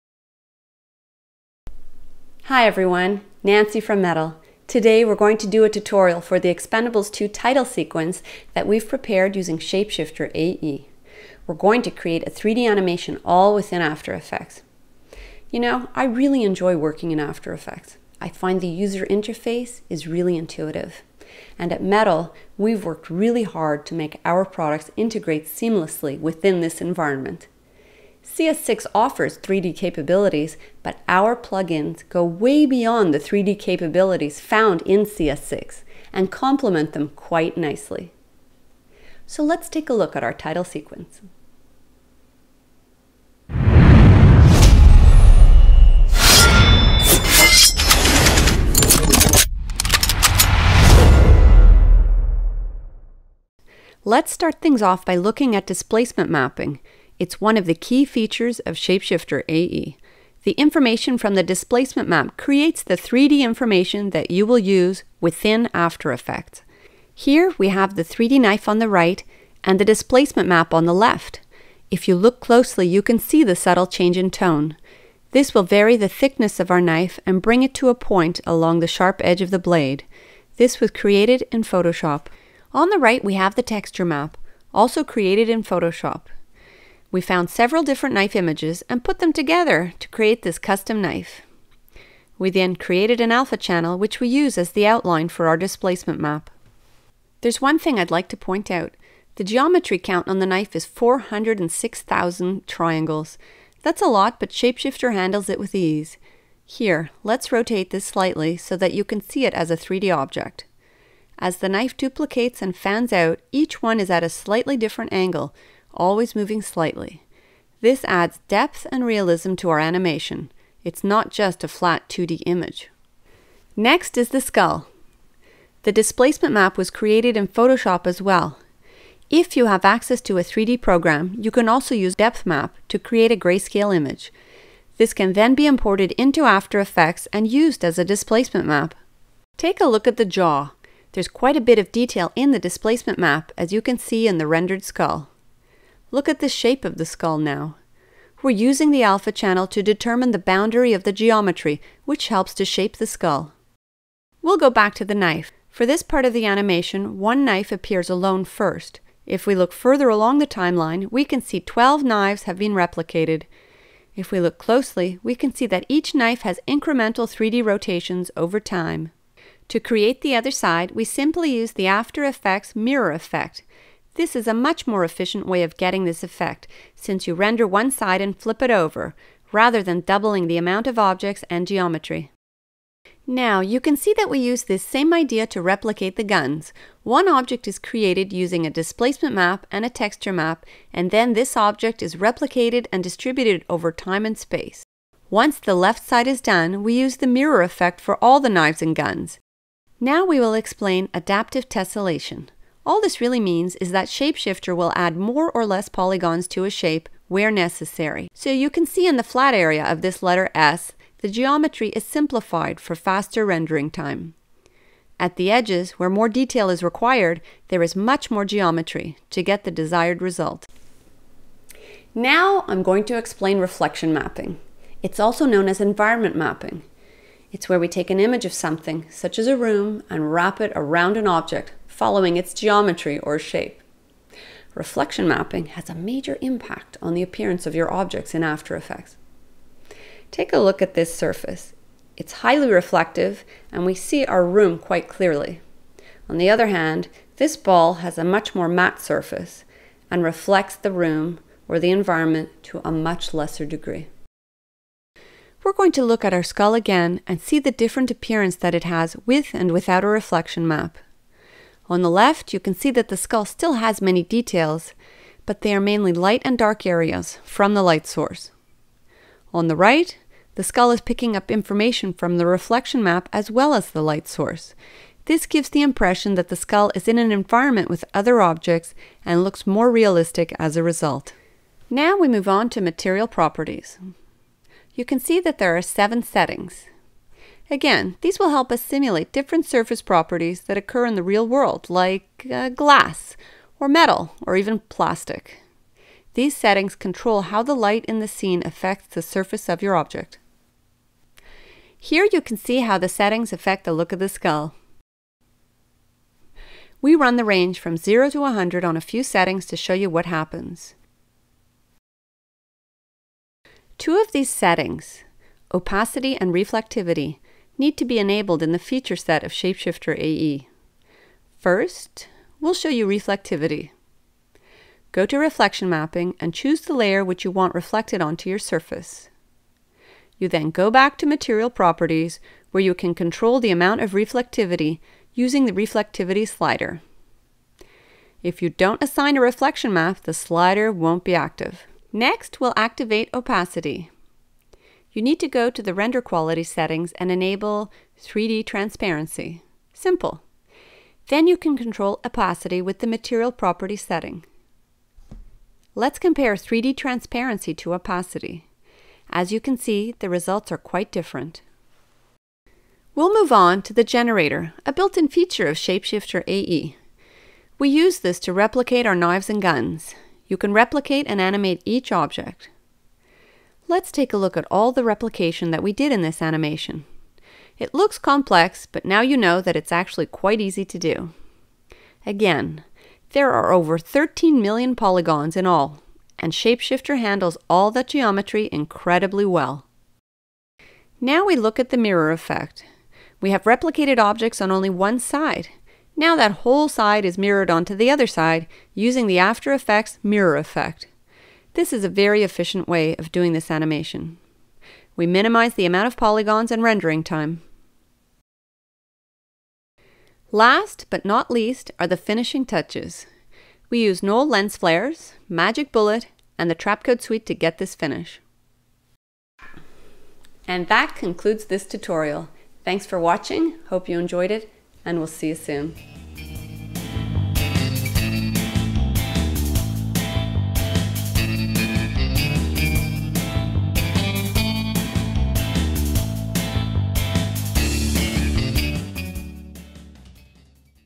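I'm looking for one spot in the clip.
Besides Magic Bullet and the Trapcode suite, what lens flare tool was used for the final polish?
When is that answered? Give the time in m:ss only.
6:54.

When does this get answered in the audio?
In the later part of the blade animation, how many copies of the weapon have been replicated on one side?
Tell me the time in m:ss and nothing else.
2:41.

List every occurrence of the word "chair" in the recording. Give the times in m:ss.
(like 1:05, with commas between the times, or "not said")
not said.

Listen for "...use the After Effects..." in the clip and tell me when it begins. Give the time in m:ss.
2:51.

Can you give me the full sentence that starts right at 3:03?
Now, you can see that we use this same idea to replicate the guns.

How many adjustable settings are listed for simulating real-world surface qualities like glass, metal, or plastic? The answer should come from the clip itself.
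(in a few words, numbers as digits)
7.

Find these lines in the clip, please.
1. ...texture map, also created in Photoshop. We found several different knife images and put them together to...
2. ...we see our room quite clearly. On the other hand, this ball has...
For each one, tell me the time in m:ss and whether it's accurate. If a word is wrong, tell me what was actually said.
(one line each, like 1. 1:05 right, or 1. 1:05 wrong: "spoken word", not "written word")
1. 1:23 right
2. 4:03 right.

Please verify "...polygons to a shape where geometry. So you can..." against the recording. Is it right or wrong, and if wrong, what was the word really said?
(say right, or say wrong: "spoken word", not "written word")
wrong: "necessary", not "geometry".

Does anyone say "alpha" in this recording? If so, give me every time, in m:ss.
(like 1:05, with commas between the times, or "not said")
1:33, 2:29.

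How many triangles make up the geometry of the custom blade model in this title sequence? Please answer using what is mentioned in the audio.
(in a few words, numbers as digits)
406,000.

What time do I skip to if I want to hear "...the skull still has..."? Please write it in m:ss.
4:23.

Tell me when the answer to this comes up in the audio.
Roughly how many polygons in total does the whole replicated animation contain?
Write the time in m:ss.
6:23.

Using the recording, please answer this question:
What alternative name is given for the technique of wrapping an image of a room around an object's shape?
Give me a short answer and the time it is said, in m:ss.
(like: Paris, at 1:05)
environment mapping, at 3:45.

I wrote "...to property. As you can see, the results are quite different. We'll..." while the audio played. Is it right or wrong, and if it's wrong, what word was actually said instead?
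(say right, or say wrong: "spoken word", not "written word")
wrong: "opacity", not "property".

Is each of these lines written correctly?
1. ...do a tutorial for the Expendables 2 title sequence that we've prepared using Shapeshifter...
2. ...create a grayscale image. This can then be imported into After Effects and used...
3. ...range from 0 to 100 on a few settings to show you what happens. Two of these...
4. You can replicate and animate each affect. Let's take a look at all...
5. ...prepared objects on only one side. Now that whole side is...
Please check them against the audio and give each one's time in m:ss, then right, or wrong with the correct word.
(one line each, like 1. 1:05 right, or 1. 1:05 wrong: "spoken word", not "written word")
1. 0:05 right
2. 2:12 right
3. 5:07 right
4. 6:10 wrong: "object", not "affect"
5. 6:33 wrong: "replicated", not "prepared".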